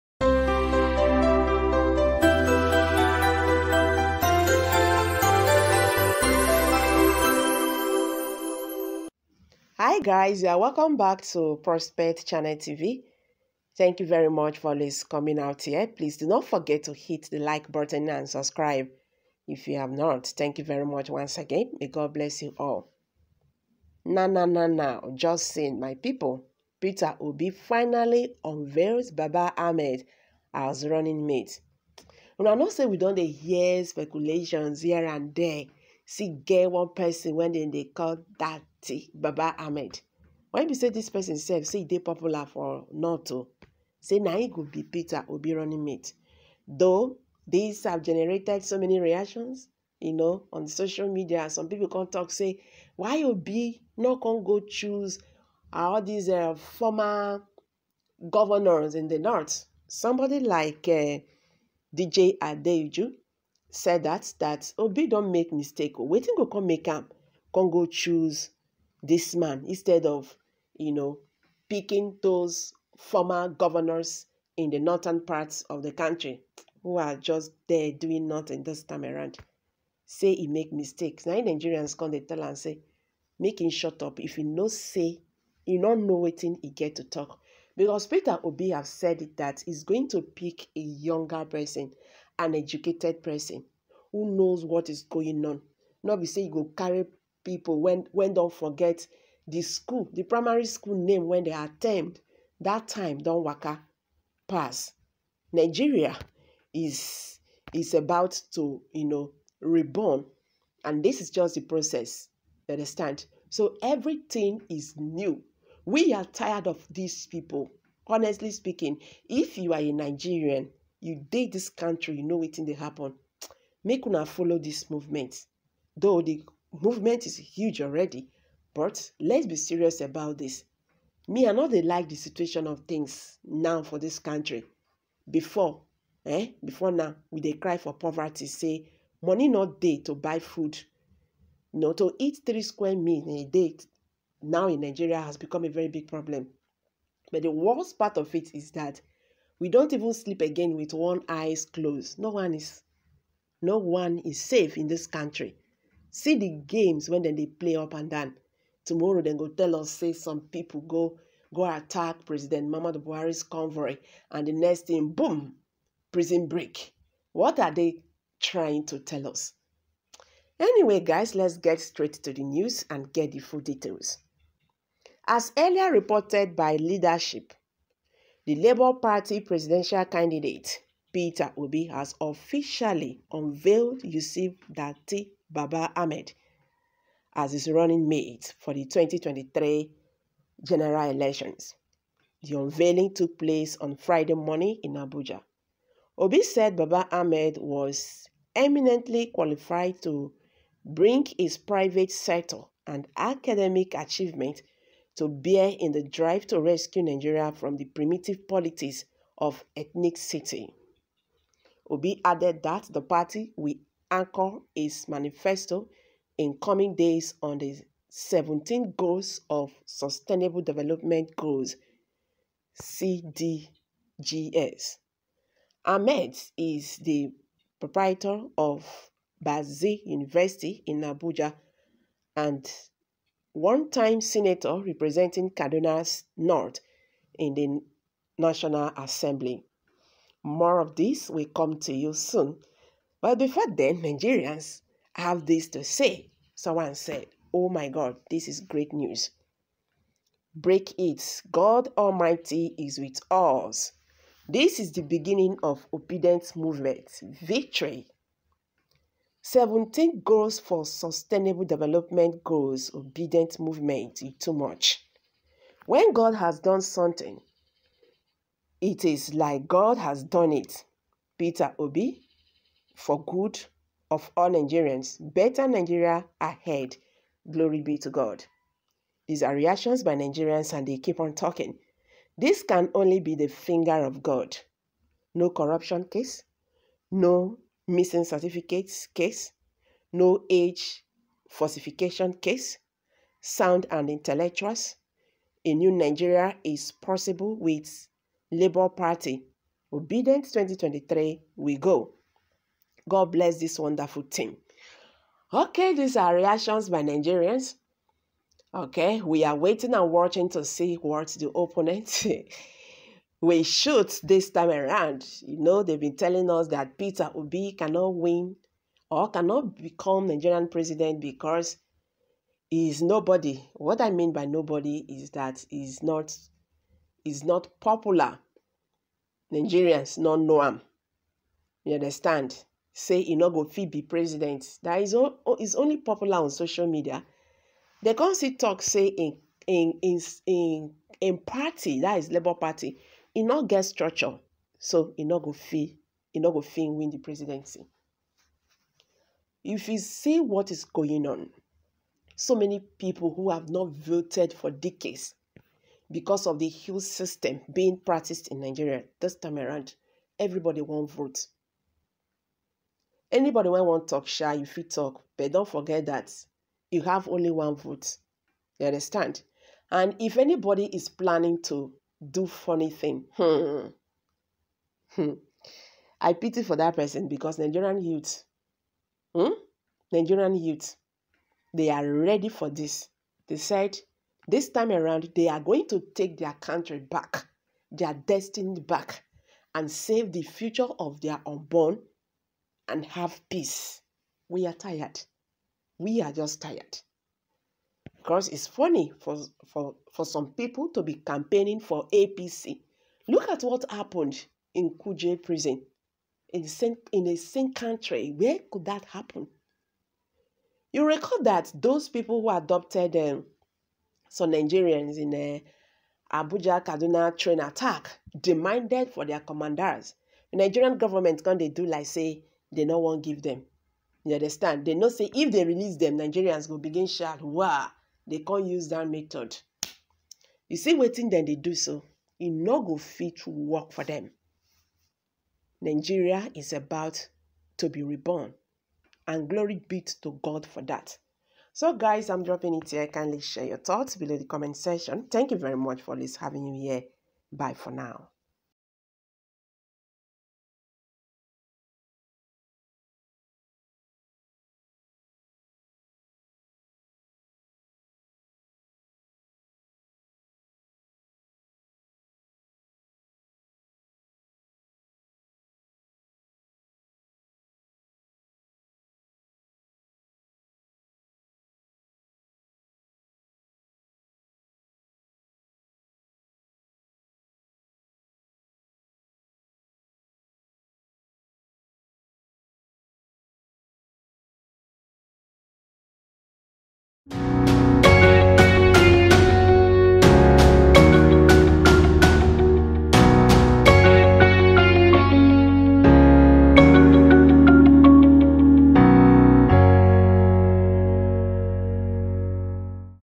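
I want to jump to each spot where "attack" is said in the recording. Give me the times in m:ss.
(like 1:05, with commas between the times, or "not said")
2:41, 6:57.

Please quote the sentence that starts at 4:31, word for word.
Peter Obi, for good of all Nigerians.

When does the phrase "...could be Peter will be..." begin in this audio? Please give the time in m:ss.
0:44.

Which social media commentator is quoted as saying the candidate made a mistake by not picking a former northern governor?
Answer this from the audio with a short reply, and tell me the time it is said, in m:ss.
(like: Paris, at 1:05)
DJ Adeju, at 1:01.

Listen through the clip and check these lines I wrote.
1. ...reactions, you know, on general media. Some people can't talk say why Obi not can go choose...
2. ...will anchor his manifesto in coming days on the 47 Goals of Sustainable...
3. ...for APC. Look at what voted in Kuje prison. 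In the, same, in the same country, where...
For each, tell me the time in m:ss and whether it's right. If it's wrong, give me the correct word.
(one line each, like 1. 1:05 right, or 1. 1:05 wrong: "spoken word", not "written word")
1. 0:48 wrong: "social", not "general"
2. 3:33 wrong: "17", not "47"
3. 6:41 wrong: "happened", not "voted".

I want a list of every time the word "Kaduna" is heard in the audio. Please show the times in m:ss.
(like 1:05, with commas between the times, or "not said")
3:55, 6:56.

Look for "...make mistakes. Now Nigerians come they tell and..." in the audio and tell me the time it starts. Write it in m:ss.
1:20.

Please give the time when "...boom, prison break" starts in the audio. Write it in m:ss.
2:45.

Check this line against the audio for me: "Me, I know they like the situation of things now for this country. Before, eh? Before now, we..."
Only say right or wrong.
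right.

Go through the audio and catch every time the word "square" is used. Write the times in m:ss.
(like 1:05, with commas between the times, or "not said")
2:22.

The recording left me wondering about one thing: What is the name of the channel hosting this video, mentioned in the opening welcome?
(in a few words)
Prospect Channel TV.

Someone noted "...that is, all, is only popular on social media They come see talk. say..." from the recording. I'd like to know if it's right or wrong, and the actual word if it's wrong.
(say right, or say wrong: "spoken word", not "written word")
right.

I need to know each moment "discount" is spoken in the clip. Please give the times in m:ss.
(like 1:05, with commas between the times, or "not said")
not said.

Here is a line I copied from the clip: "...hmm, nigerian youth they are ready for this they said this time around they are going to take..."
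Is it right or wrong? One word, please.
right.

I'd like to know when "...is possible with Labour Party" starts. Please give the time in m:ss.
4:56.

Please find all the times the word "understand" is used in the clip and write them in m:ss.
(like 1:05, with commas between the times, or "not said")
1:52, 5:31, 6:08, 7:04.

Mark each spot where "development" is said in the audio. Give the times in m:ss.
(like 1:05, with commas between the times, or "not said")
3:40, 4:21.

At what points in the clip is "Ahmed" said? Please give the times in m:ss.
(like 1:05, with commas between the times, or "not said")
0:29, 0:39, 3:05, 3:17, 3:45.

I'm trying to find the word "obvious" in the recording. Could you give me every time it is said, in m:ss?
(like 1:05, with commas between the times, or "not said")
not said.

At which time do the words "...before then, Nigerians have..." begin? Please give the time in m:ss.
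4:03.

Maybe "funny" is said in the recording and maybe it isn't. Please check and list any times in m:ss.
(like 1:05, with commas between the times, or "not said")
6:12, 6:38.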